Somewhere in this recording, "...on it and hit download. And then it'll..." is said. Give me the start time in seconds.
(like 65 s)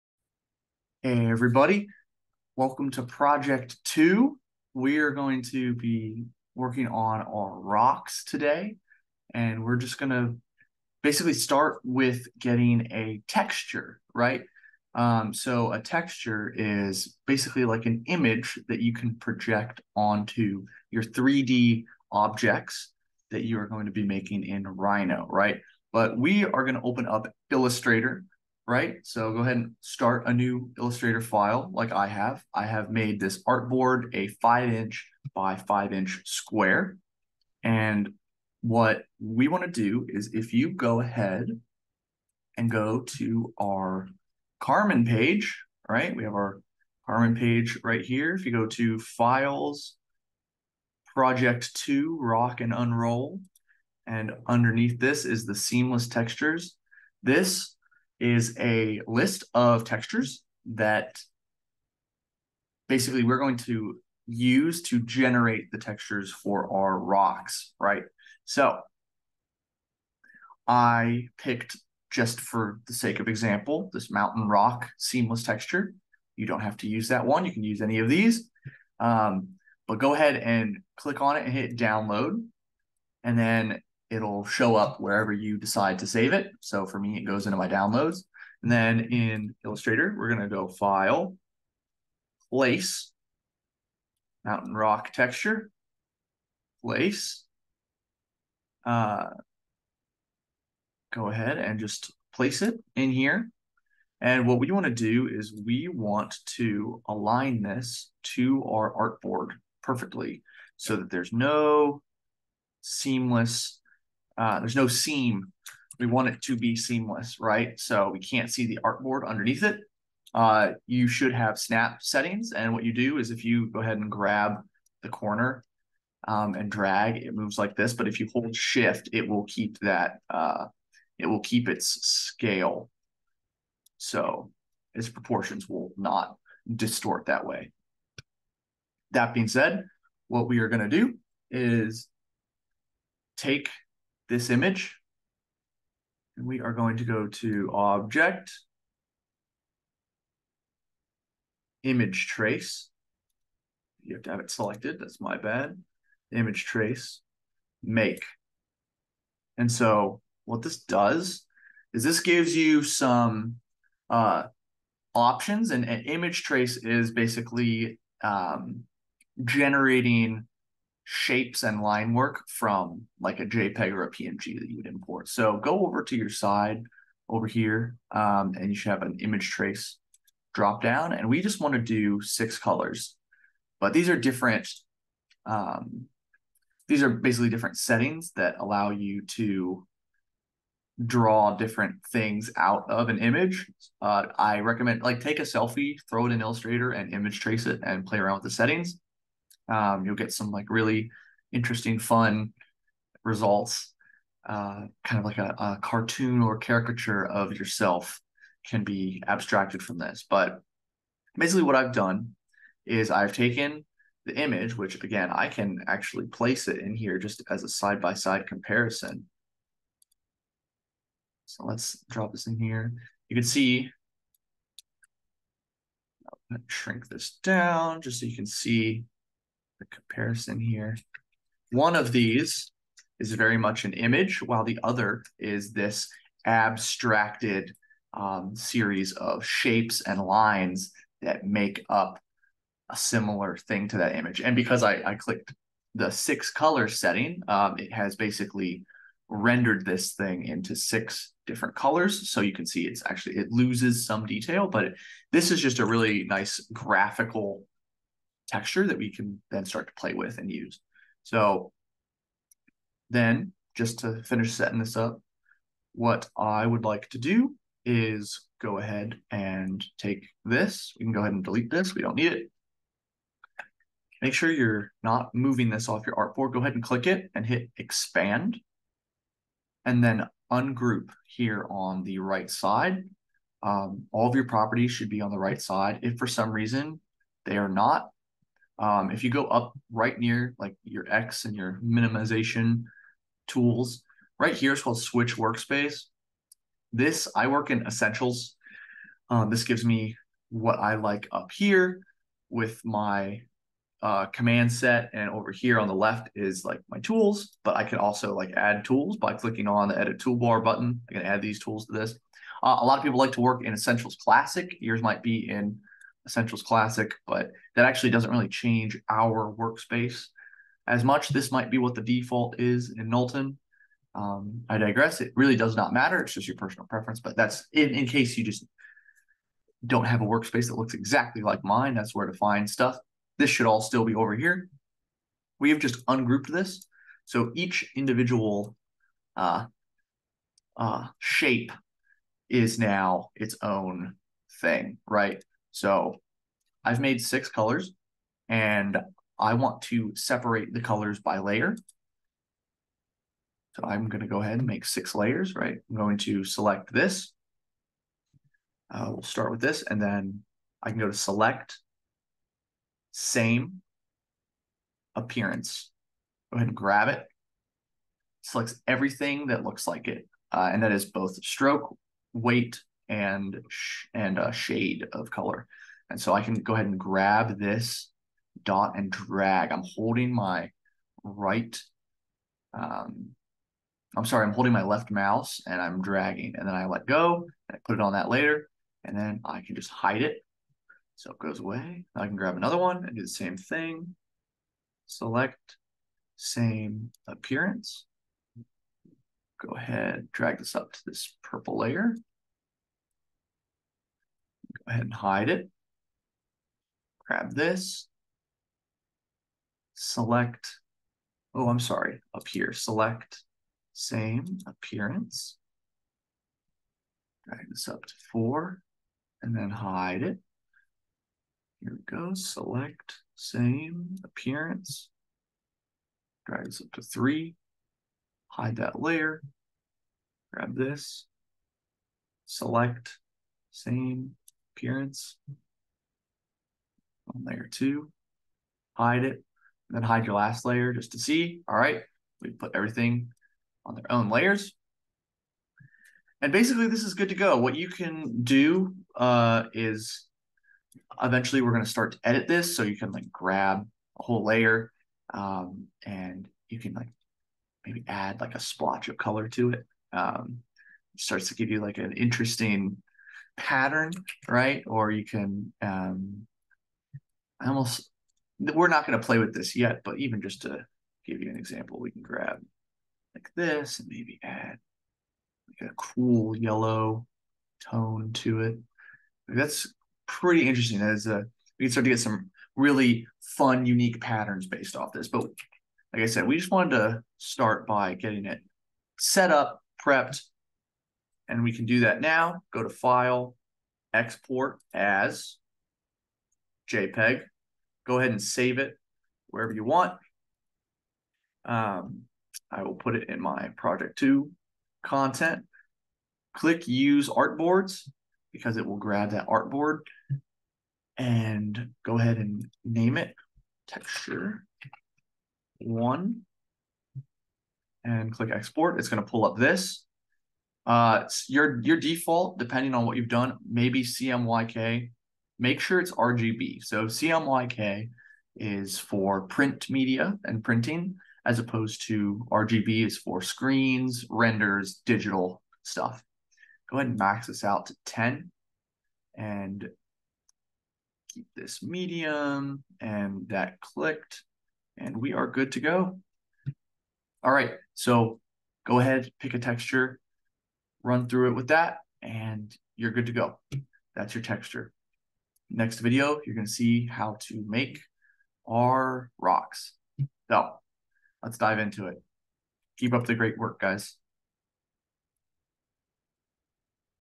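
81 s.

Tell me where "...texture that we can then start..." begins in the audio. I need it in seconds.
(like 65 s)
258 s.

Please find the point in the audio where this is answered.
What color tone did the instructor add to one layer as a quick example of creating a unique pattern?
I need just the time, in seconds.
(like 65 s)
476 s.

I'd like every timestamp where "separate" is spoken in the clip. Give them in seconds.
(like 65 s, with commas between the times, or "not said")
350 s.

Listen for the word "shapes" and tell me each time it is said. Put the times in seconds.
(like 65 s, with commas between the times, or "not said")
171 s, 239 s, 341 s.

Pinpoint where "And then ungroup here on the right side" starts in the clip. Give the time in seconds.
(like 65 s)
279 s.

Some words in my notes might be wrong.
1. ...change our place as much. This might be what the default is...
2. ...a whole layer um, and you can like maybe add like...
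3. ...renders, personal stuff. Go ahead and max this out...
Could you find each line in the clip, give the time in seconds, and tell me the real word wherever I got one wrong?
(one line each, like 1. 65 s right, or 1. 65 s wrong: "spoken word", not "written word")
1. 318 s wrong: "workspace", not "place"
2. 454 s right
3. 534 s wrong: "digital", not "personal".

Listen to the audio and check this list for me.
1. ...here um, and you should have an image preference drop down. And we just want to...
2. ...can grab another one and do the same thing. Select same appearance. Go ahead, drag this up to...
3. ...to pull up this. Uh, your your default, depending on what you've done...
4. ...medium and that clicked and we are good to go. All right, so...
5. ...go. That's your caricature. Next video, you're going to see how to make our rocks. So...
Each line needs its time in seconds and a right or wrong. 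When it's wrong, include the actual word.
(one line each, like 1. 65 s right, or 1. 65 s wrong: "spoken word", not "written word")
1. 177 s wrong: "trace", not "preference"
2. 392 s right
3. 519 s right
4. 541 s right
5. 553 s wrong: "texture", not "caricature".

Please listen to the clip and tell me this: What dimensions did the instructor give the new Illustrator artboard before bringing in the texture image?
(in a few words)
5 inch by 5 inch.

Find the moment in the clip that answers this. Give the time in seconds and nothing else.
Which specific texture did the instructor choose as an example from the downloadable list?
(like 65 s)
74 s.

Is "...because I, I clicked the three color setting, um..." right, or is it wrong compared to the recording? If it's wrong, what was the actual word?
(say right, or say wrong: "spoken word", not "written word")
wrong: "six", not "three".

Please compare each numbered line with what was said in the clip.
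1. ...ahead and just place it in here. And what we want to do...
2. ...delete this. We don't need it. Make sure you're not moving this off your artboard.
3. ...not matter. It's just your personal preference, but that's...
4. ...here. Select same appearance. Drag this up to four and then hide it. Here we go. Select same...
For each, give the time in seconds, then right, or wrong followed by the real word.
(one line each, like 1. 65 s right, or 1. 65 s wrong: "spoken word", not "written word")
1. 101 s right
2. 271 s right
3. 325 s right
4. 412 s right.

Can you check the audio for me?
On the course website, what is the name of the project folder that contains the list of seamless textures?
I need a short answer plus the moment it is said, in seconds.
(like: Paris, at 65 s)
Rock and unroll, at 52 s.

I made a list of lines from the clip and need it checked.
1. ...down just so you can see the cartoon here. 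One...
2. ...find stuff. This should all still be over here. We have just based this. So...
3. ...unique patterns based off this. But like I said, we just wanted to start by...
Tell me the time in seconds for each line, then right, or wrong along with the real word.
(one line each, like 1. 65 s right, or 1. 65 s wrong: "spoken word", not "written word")
1. 227 s wrong: "comparison", not "cartoon"
2. 332 s wrong: "ungrouped", not "based"
3. 483 s right.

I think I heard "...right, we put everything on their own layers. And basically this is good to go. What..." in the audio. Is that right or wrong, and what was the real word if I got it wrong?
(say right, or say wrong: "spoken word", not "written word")
right.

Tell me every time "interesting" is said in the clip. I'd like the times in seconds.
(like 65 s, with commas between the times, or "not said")
201 s, 462 s, 480 s.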